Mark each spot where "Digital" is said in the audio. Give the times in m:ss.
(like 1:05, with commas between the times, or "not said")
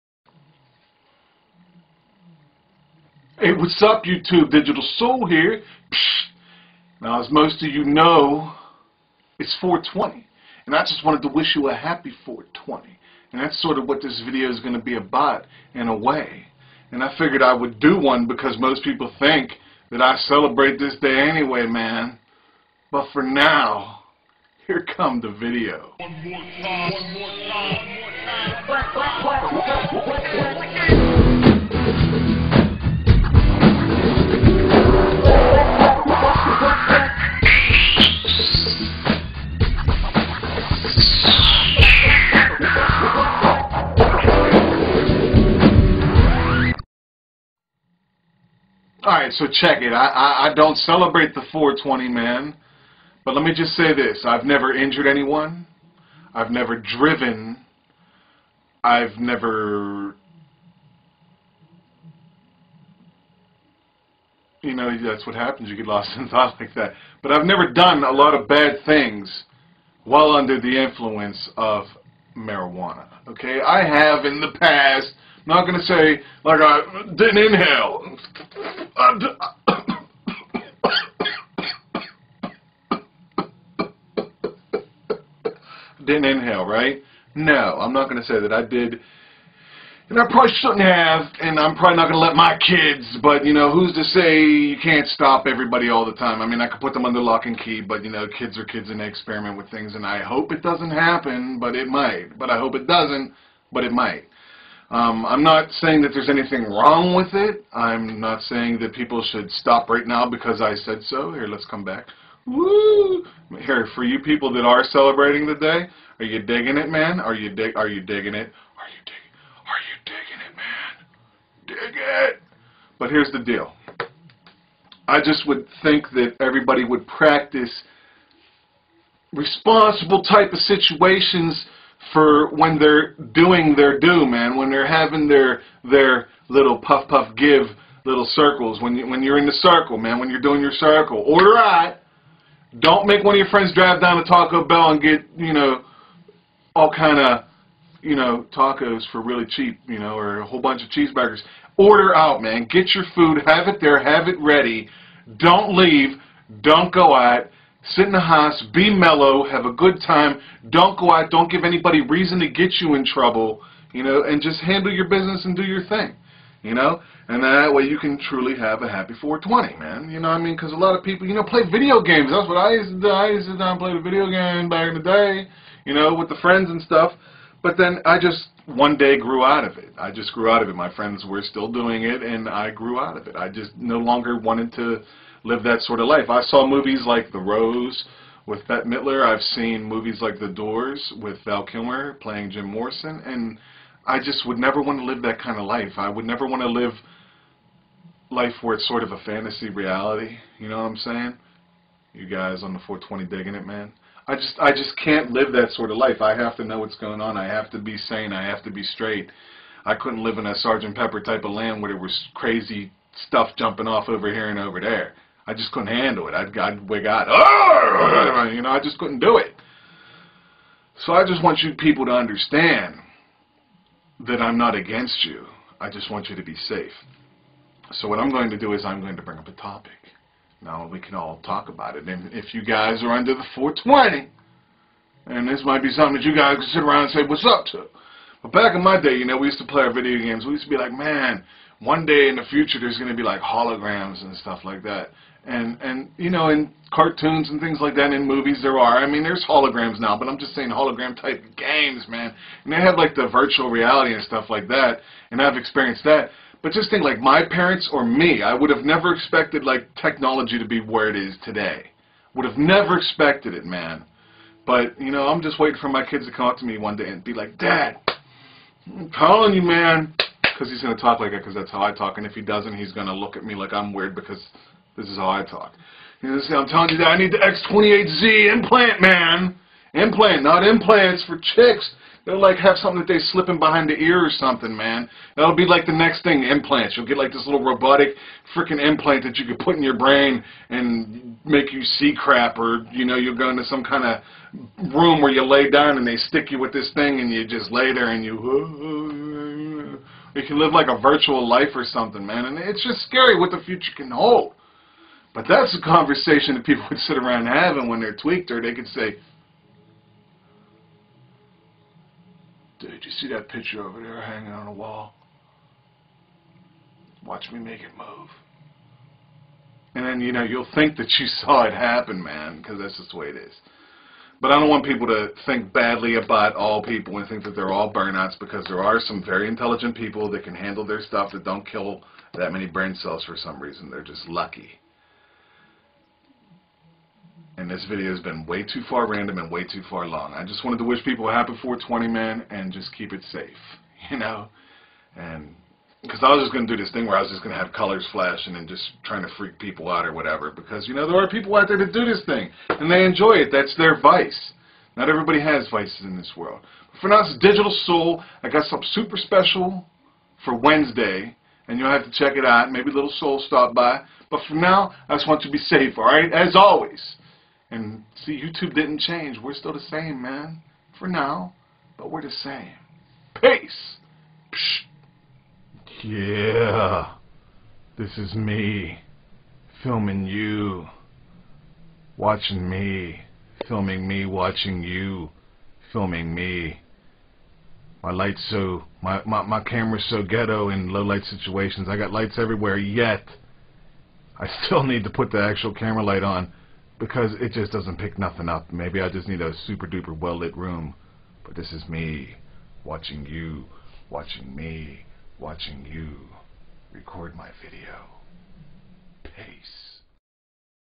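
0:04, 5:57.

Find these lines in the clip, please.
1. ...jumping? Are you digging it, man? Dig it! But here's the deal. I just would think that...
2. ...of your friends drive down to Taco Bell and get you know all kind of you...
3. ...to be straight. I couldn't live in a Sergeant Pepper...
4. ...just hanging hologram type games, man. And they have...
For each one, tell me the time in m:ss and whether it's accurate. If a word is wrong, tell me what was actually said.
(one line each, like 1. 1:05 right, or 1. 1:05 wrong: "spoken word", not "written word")
1. 1:59 wrong: "digging", not "jumping"
2. 2:23 right
3. 3:28 right
4. 4:10 wrong: "saying", not "hanging".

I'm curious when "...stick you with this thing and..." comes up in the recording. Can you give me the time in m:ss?
4:56.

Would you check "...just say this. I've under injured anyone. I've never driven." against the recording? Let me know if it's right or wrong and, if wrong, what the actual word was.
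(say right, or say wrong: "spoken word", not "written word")
wrong: "never", not "under".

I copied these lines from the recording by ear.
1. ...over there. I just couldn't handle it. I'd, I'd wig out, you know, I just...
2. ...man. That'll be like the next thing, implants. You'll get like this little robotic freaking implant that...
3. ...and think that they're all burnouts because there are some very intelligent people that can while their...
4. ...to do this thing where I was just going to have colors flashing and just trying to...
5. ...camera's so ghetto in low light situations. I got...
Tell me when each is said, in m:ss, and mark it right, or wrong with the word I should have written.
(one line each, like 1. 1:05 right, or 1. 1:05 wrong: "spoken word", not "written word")
1. 3:34 right
2. 4:44 right
3. 5:27 wrong: "handle", not "while"
4. 5:46 right
5. 6:29 right.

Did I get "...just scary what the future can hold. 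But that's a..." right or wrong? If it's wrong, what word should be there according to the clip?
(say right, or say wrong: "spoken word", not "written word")
right.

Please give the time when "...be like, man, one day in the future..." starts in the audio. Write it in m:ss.
4:00.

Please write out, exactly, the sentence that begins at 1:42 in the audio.
But I hope it doesn't, but it might.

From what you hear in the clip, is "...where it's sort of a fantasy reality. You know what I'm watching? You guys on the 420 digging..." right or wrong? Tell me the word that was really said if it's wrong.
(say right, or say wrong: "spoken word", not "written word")
wrong: "saying", not "watching".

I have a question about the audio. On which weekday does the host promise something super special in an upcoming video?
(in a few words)
Wednesday.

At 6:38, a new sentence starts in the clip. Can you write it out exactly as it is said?
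Maybe I just need a super duper well lit room.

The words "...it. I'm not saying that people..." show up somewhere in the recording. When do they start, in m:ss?
1:47.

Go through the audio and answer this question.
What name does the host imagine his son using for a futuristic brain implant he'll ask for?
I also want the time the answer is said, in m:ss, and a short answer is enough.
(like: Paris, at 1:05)
X28Z implant, at 4:37.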